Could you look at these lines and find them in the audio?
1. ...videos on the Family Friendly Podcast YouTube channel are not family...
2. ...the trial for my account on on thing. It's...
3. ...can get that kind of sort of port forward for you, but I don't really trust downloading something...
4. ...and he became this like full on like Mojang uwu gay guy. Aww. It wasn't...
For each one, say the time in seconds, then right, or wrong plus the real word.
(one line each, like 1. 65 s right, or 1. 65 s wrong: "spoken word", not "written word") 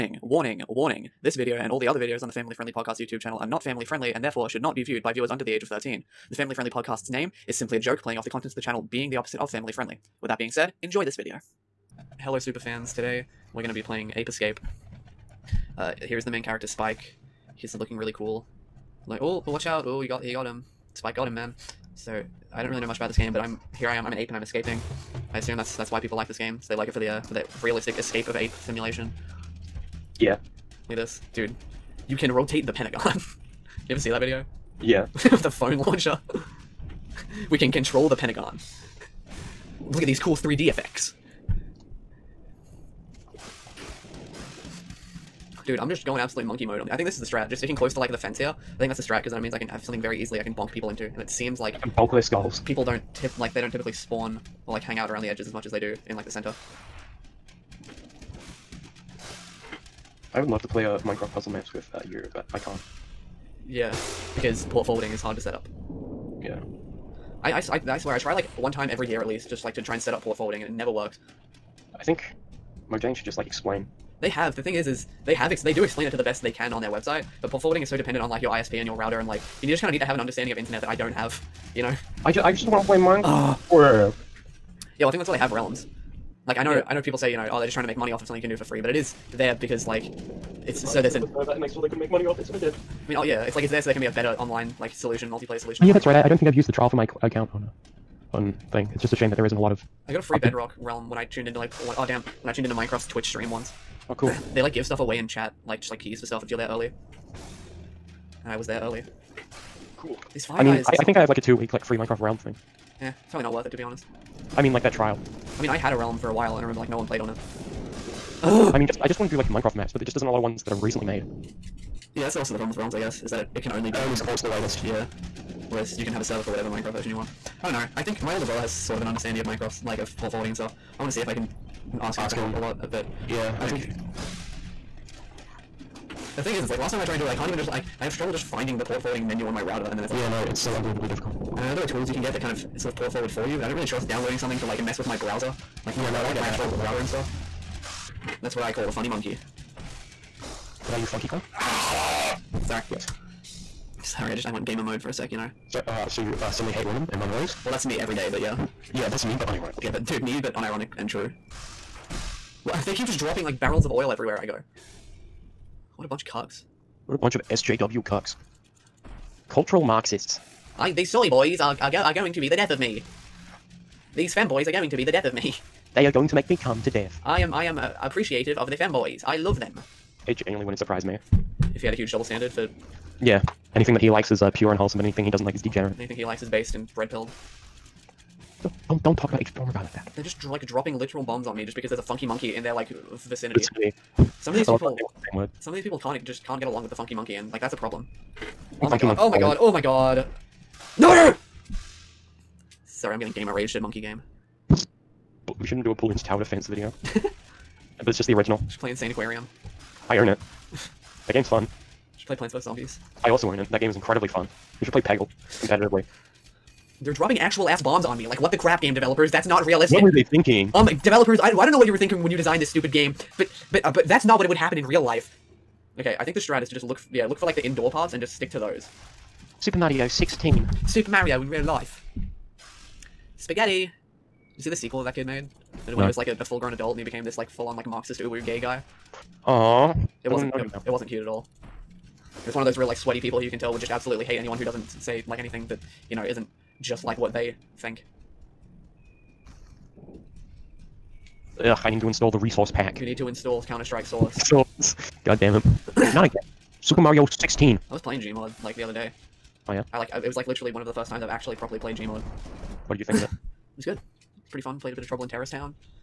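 1. 1 s right
2. 96 s right
3. 142 s right
4. 236 s wrong: "Marxist", not "Mojang".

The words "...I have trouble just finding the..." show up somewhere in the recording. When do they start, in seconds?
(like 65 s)
138 s.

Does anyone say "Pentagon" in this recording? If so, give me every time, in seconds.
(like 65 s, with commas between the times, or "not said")
32 s, 38 s.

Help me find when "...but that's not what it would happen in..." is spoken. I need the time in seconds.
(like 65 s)
223 s.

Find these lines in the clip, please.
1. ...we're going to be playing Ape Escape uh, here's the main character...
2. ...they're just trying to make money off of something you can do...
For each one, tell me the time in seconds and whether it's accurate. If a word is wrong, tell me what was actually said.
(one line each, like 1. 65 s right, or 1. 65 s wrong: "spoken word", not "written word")
1. 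13 s right
2. 87 s right.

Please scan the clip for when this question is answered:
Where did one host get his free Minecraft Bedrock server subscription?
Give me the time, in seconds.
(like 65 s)
102 s.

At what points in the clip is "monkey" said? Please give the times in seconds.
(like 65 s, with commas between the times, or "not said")
46 s, 149 s, 192 s, 197 s, 203 s.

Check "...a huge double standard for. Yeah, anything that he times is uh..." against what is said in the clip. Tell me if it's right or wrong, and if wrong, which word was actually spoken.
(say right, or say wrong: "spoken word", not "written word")
wrong: "likes", not "times".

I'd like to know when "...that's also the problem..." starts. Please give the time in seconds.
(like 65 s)
122 s.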